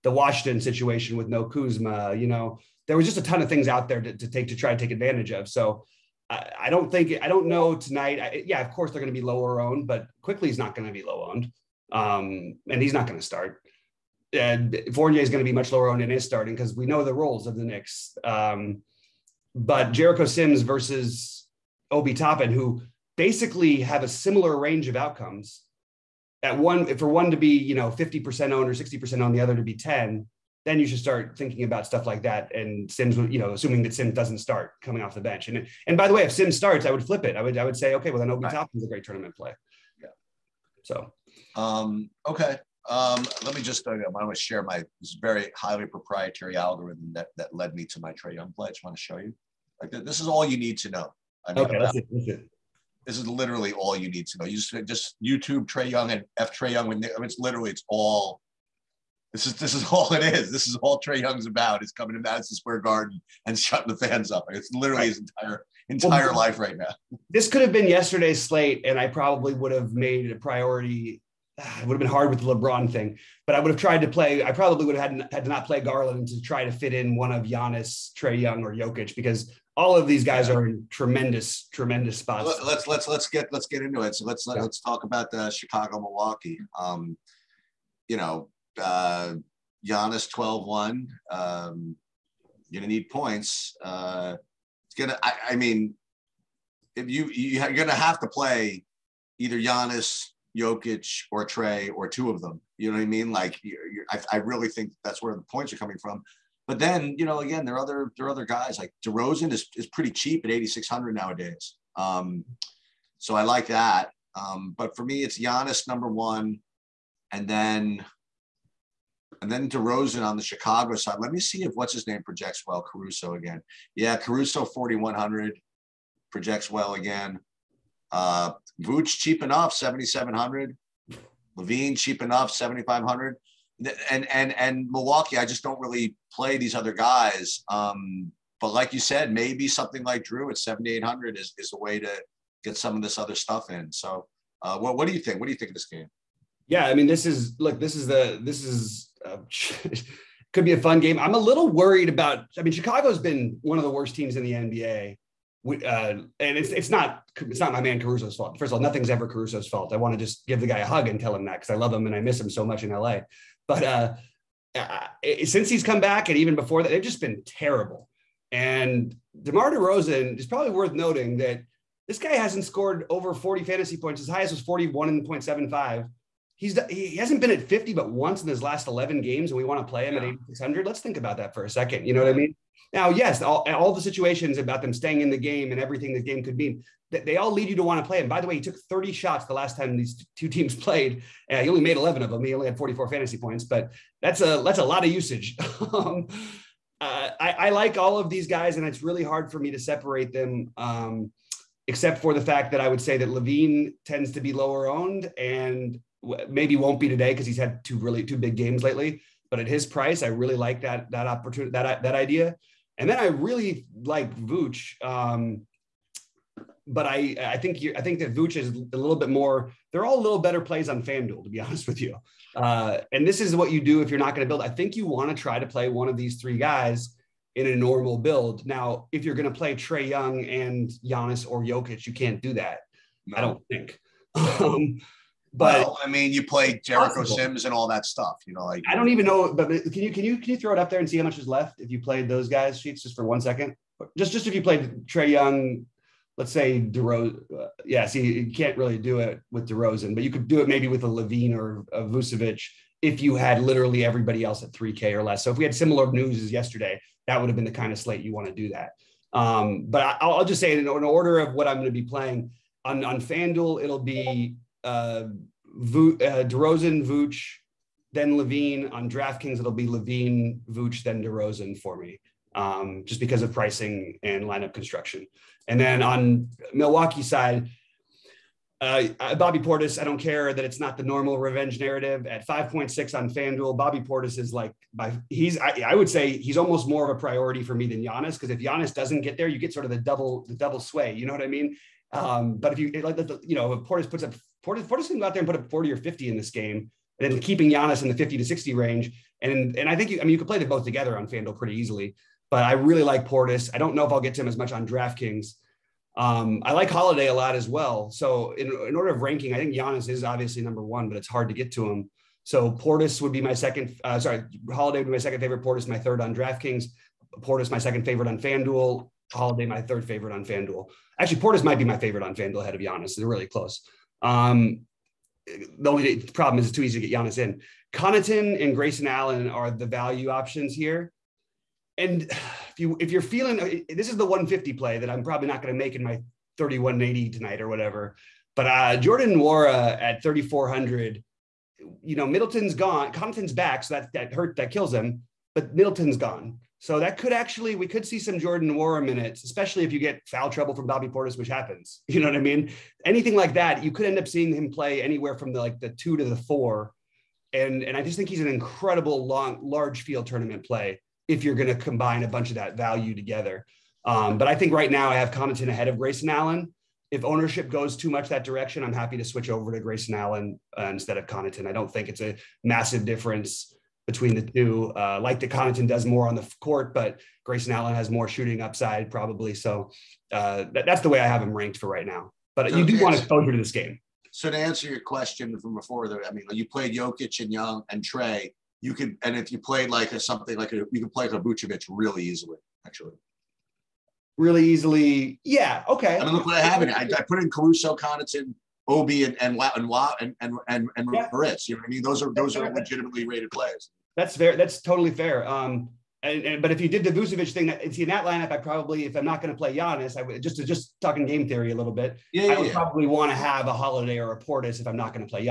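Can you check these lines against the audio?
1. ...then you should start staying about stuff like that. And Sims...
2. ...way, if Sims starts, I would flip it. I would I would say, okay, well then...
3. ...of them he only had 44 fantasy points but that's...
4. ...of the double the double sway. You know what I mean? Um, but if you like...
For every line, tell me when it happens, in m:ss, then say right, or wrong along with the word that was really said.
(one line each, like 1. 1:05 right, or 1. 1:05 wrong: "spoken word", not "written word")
1. 0:30 wrong: "thinking", not "staying"
2. 0:36 right
3. 3:12 right
4. 4:49 right.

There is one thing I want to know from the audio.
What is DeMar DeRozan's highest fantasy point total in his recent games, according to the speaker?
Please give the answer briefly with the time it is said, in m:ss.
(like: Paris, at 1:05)
41.75, at 2:54.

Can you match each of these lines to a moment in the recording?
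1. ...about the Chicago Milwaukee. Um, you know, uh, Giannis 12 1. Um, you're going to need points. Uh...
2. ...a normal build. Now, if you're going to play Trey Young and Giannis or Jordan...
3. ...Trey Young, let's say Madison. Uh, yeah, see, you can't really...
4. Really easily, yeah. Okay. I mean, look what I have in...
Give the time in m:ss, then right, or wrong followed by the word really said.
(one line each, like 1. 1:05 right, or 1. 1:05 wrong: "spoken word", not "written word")
1. 1:25 right
2. 3:47 wrong: "Jokic", not "Jordan"
3. 4:05 wrong: "DeRozan", not "Madison"
4. 6:34 right.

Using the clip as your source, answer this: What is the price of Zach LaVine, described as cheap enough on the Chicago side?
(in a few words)
7,500.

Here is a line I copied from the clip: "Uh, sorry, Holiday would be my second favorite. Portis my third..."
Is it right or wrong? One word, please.
right.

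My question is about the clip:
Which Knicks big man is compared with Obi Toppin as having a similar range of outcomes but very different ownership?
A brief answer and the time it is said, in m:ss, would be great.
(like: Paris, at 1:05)
Jericho Sims, at 0:19.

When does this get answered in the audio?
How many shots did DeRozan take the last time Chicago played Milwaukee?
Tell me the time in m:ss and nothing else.
3:08.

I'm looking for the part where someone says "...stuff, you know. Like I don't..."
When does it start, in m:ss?
3:58.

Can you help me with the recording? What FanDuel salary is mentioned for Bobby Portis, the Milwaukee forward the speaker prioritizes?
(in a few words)
5.6.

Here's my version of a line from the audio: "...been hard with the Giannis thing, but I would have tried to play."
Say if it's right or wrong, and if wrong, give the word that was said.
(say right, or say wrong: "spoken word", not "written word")
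wrong: "LeBron", not "Giannis".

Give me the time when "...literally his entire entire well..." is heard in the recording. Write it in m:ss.
1:04.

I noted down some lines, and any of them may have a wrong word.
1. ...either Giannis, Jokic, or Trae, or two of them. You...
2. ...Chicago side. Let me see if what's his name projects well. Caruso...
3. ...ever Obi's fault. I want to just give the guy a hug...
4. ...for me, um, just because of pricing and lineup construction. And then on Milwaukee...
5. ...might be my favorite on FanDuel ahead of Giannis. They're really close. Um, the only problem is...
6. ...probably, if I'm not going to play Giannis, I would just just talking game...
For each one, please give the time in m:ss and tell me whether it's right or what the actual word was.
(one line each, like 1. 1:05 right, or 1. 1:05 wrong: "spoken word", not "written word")
1. 1:39 right
2. 2:00 right
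3. 2:39 wrong: "Caruso", not "Obi"
4. 4:31 right
5. 5:21 right
6. 6:48 right.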